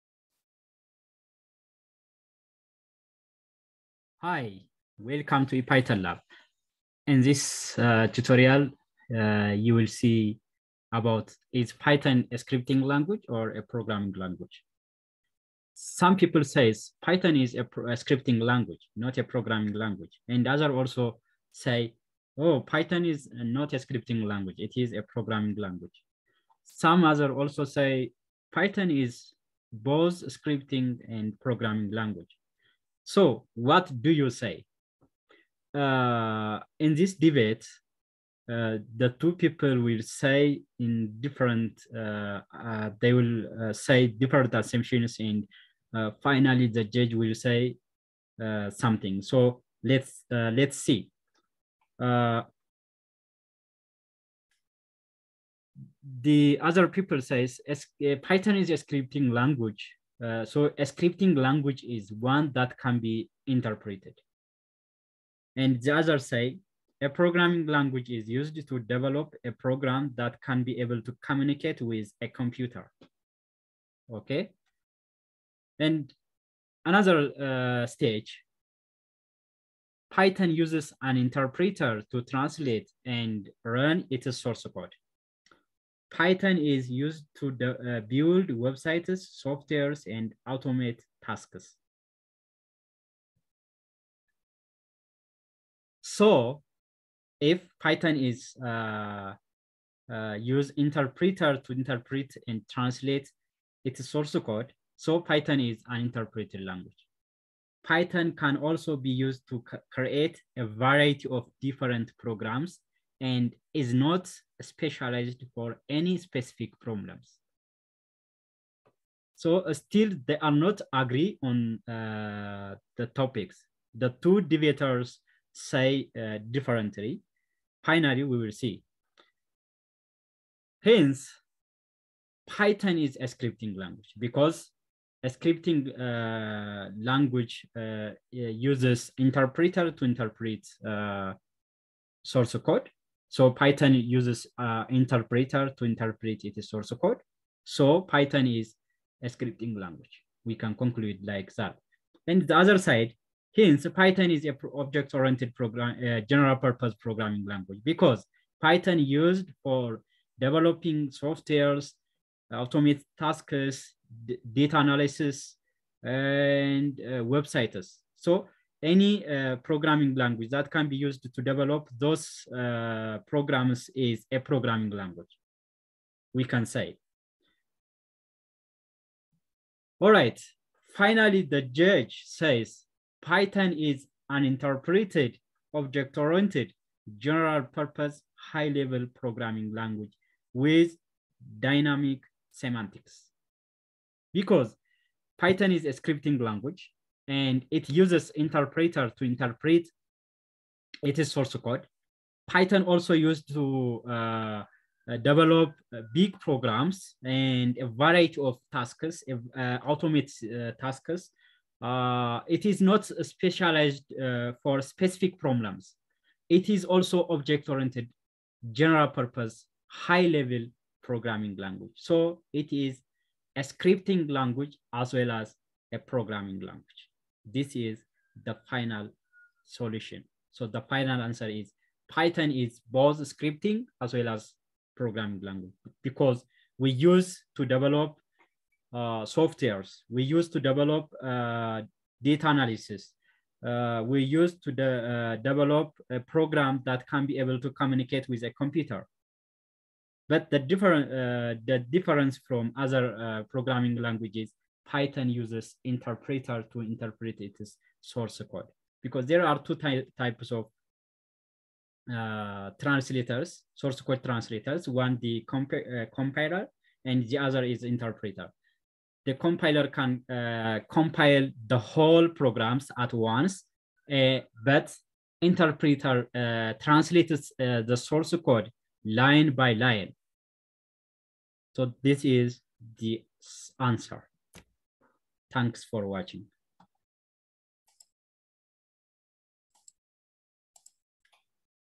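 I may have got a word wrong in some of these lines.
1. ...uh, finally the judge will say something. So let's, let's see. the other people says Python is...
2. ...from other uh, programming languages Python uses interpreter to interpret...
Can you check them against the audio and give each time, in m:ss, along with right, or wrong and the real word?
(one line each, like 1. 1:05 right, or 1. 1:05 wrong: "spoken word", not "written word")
1. 0:45 right
2. 4:12 right.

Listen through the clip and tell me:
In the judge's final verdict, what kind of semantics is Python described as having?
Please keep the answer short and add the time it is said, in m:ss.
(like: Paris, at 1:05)
dynamic semantics, at 3:11.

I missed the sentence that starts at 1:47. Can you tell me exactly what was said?
Python can also be used to create a variety of different programs and is not specialized for any specific problems.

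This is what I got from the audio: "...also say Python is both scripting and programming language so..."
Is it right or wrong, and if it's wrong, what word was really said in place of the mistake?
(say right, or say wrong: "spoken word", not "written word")
right.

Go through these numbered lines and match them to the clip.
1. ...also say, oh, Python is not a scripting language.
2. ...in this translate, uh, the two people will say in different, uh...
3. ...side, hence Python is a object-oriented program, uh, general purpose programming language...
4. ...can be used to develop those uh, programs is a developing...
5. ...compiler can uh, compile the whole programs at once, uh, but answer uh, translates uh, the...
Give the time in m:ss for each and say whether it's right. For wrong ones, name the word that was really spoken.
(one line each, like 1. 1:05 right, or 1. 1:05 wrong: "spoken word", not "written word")
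1. 0:20 right
2. 0:36 wrong: "debate", not "translate"
3. 2:32 right
4. 2:50 wrong: "programming", not "developing"
5. 4:29 wrong: "interpreter", not "answer".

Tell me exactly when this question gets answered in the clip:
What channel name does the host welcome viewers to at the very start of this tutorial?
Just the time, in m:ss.
0:05.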